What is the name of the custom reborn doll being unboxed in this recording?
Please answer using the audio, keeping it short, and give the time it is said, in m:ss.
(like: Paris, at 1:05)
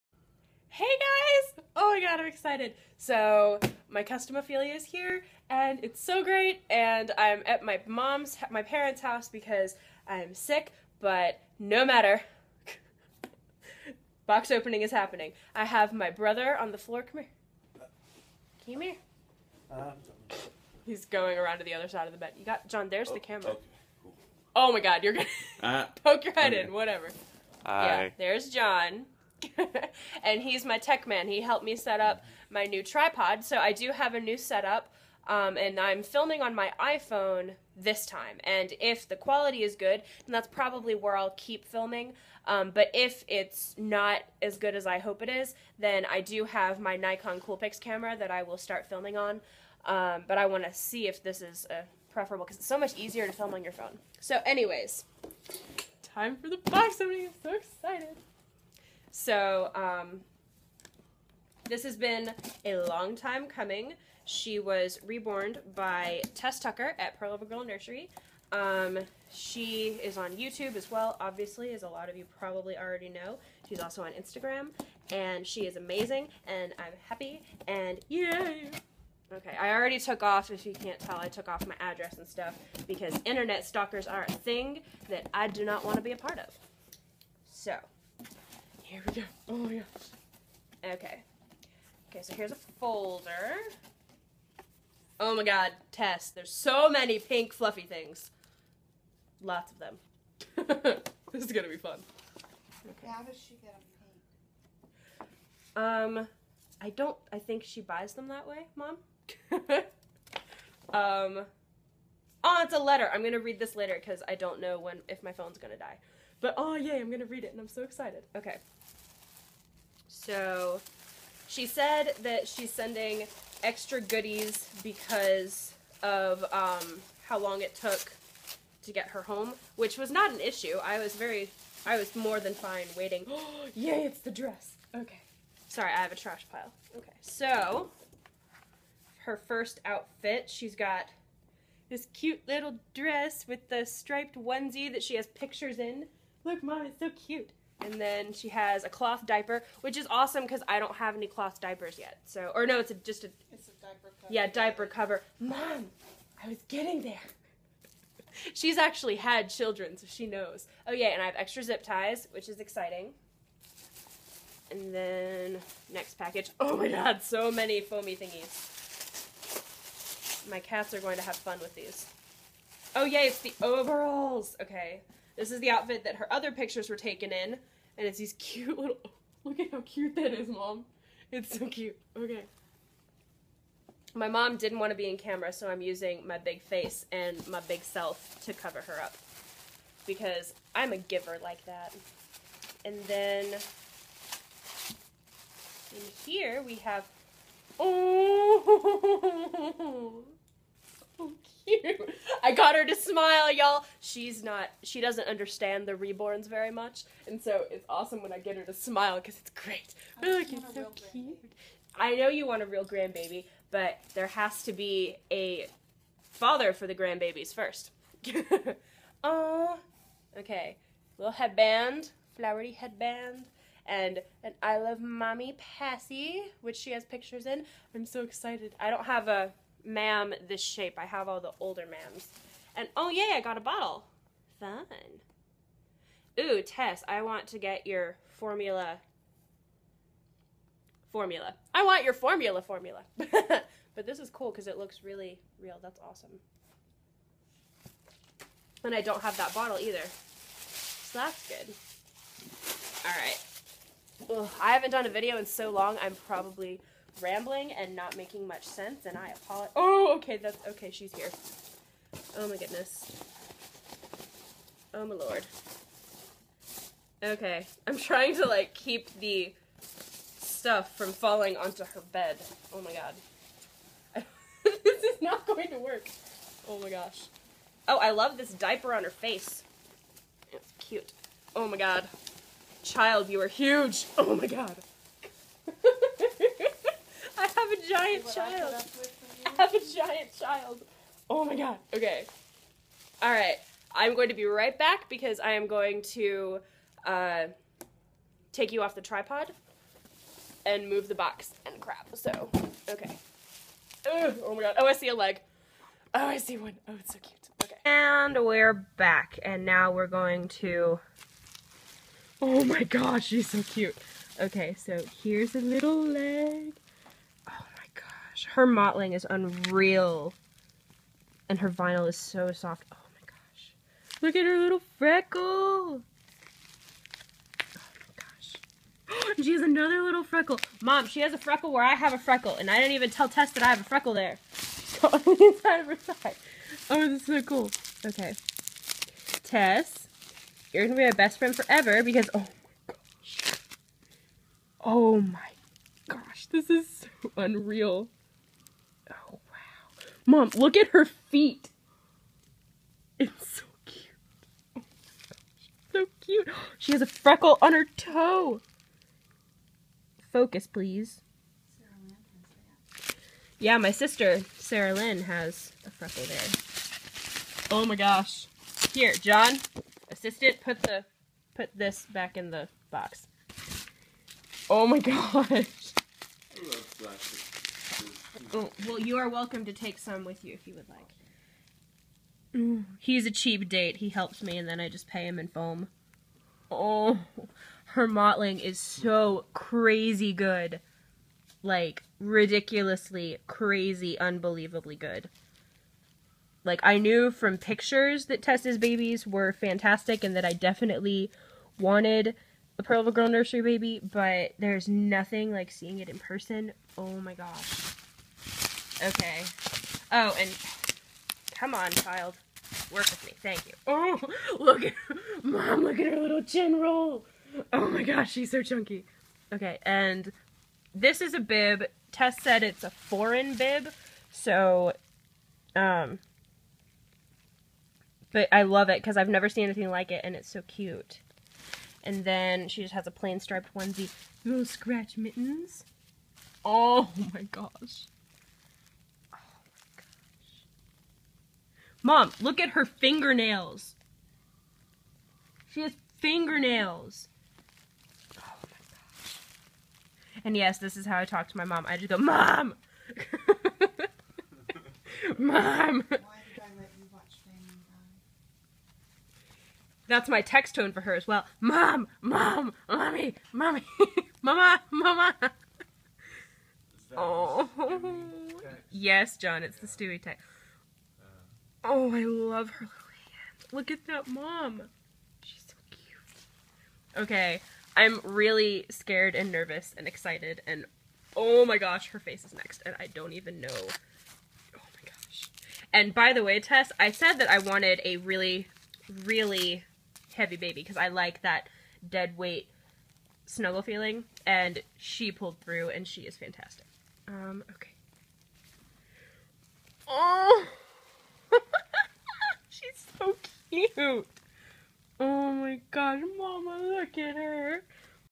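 Ophelia, at 0:04.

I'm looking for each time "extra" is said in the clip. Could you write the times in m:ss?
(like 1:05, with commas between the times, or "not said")
2:03, 2:41.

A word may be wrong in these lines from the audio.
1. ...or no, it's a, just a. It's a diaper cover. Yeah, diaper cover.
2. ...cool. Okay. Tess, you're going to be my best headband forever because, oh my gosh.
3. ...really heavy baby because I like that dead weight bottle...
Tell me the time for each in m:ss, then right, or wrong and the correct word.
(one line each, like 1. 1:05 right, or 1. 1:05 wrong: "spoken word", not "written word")
1. 2:32 right
2. 5:37 wrong: "friend", not "headband"
3. 8:09 wrong: "snuggle", not "bottle".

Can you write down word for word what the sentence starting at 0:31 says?
He helped me set up my new tripod.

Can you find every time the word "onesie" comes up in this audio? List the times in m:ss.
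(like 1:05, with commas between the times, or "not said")
2:24, 7:13.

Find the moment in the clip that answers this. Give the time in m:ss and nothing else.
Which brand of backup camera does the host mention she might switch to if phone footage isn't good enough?
0:46.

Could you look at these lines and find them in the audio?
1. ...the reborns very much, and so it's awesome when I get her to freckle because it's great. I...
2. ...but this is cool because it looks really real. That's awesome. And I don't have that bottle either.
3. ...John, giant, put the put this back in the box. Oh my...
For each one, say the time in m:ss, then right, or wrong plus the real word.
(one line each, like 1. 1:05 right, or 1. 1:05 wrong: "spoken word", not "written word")
1. 3:25 wrong: "smile", not "freckle"
2. 4:03 right
3. 6:09 wrong: "assistant", not "giant".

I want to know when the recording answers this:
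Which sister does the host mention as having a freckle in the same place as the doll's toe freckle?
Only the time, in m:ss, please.
6:04.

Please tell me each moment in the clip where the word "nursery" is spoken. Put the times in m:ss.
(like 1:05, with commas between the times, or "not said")
1:07, 6:43.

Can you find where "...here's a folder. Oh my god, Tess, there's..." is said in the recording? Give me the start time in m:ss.
1:32.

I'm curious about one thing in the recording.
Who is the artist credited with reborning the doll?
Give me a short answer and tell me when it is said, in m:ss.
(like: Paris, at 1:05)
Tess Tucker, at 1:06.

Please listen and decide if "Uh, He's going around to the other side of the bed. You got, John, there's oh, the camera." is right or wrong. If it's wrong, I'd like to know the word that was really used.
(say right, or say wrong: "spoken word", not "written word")
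right.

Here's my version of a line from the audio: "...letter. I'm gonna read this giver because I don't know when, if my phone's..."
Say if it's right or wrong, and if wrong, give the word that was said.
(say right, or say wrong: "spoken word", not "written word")
wrong: "later", not "giver".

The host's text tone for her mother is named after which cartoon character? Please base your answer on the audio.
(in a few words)
Stewie.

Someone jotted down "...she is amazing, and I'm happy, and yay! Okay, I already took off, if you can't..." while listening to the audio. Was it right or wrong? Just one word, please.
right.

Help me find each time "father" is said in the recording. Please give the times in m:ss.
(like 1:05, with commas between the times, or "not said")
3:36.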